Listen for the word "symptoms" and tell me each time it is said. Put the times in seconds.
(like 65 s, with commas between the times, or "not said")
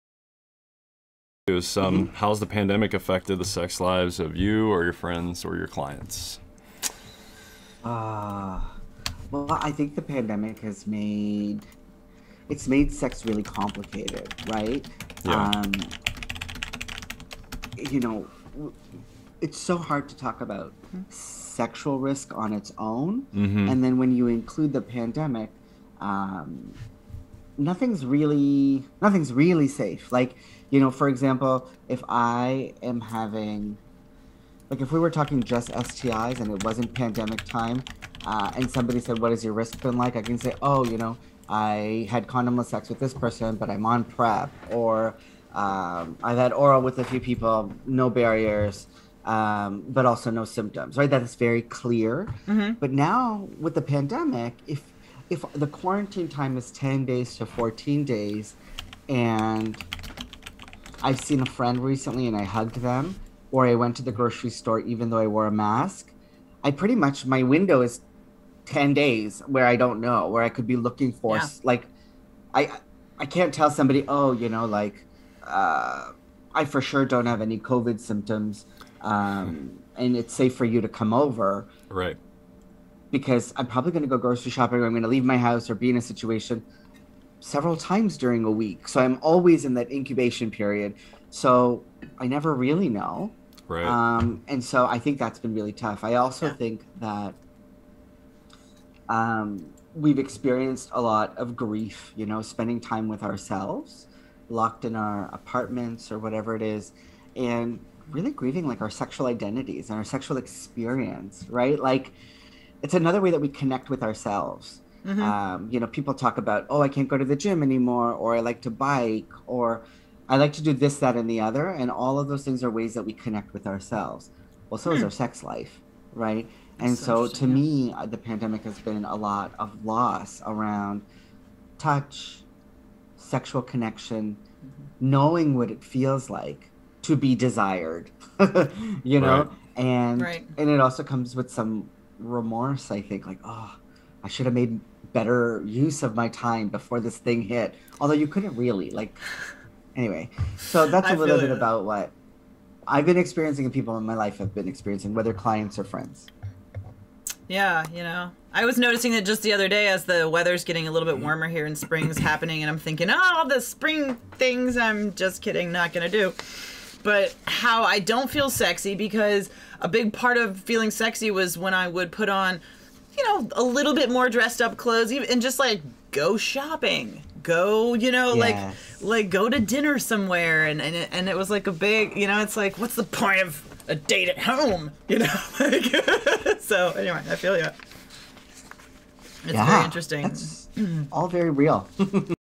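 50 s, 77 s.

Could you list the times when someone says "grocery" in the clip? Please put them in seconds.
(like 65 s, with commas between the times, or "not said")
64 s, 84 s.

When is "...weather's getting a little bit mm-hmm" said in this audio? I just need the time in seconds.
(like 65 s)
160 s.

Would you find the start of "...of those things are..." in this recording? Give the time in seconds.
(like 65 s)
122 s.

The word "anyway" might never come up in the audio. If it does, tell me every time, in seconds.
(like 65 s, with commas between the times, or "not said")
149 s, 186 s.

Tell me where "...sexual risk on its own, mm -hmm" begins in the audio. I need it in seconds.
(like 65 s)
21 s.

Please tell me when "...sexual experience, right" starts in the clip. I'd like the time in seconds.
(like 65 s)
110 s.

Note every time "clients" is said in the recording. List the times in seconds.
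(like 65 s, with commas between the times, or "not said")
5 s, 155 s.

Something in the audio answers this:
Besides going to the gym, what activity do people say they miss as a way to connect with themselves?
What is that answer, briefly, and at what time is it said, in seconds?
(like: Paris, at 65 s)
bike, at 118 s.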